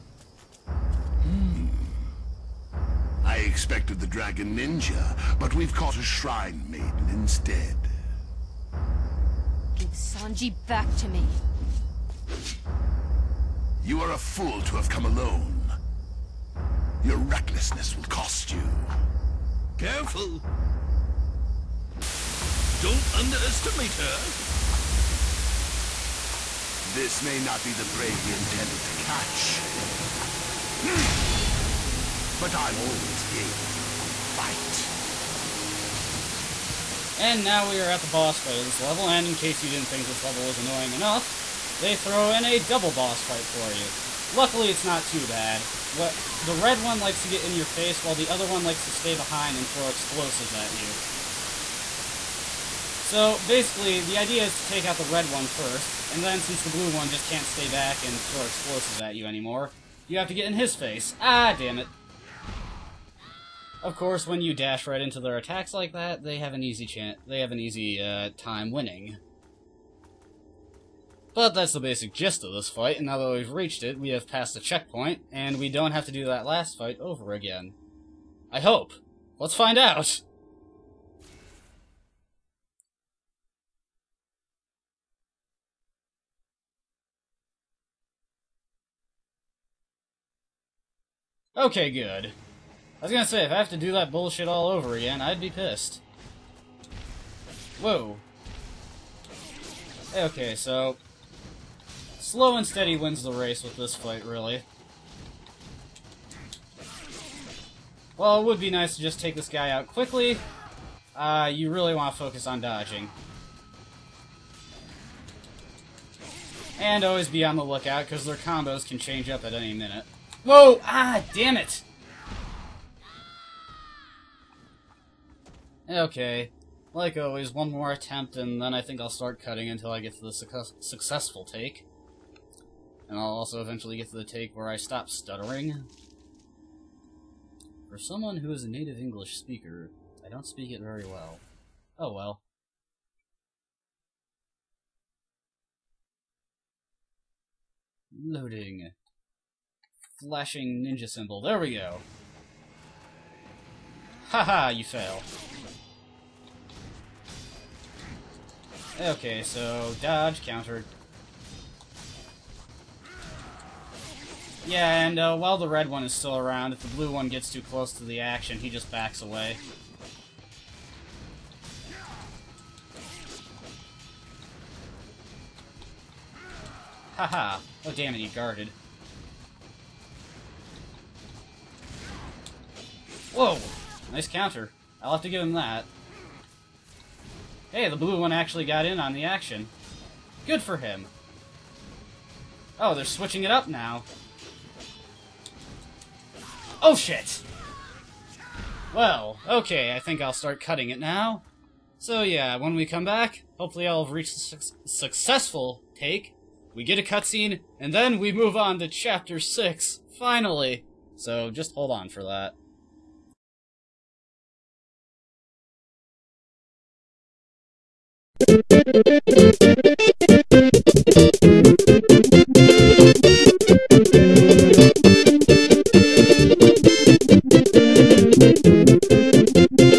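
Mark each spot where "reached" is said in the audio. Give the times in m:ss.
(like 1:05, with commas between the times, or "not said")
1:13, 3:24.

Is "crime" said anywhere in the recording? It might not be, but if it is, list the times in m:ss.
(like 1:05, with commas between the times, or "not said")
not said.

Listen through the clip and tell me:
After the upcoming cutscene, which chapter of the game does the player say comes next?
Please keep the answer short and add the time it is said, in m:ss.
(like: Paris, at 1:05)
Chapter 6, at 3:28.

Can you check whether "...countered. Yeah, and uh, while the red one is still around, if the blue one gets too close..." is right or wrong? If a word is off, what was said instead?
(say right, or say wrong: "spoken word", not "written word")
right.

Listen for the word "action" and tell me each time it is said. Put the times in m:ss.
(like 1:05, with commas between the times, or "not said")
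2:48, 3:09.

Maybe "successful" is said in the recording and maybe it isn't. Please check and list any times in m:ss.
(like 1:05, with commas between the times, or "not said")
2:10, 3:24.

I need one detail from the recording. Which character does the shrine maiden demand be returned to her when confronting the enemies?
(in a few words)
Sanji.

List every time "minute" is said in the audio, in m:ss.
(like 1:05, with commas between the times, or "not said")
1:59.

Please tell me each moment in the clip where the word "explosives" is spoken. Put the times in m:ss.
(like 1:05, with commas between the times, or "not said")
0:49, 0:58.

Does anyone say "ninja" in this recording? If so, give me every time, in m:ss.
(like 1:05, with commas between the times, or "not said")
0:04, 2:30.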